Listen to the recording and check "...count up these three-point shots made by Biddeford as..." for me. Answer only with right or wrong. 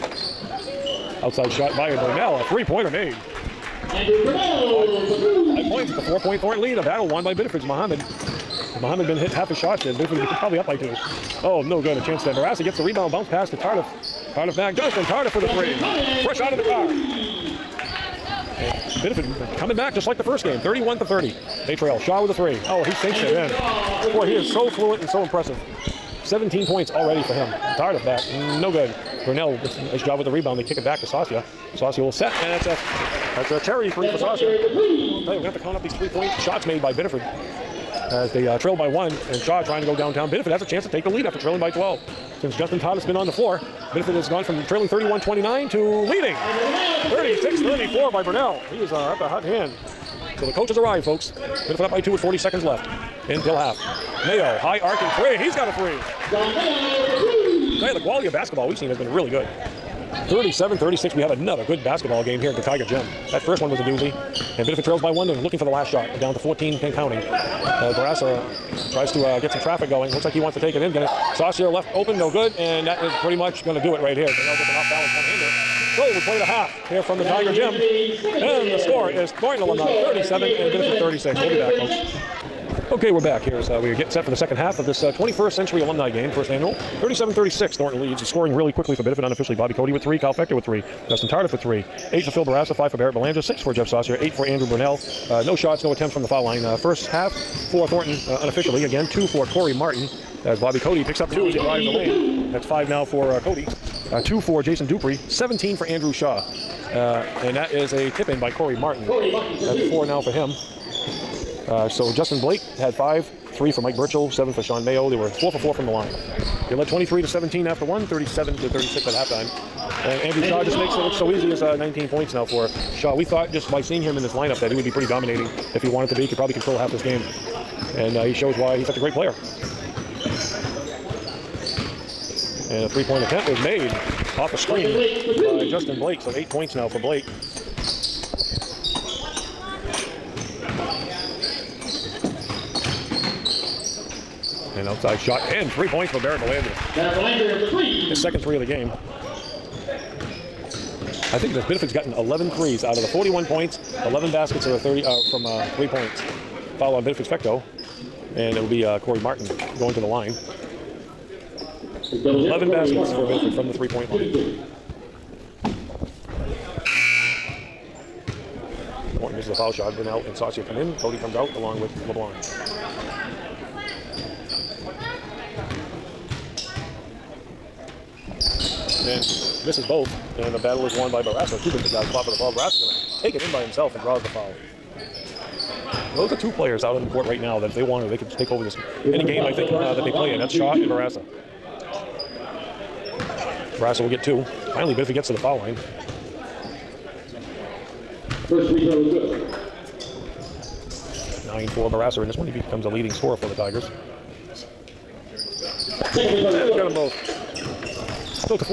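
right.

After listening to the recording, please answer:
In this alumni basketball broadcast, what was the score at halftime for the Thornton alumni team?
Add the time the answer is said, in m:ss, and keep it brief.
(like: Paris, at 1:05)
37, at 1:19.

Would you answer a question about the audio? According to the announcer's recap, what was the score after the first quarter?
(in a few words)
23 to 17.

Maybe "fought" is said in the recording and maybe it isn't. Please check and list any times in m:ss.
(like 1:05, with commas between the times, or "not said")
3:02.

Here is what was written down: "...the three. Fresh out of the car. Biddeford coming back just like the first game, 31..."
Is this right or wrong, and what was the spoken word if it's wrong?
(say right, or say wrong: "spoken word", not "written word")
right.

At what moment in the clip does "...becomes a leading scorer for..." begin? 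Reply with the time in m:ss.
3:22.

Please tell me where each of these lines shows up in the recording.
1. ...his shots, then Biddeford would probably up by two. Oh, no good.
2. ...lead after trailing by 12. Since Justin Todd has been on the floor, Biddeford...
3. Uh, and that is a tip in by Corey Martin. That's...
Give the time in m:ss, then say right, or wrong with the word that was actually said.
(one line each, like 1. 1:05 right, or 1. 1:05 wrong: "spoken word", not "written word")
1. 0:09 right
2. 0:41 right
3. 1:46 right.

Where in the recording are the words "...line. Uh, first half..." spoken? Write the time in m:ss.
1:36.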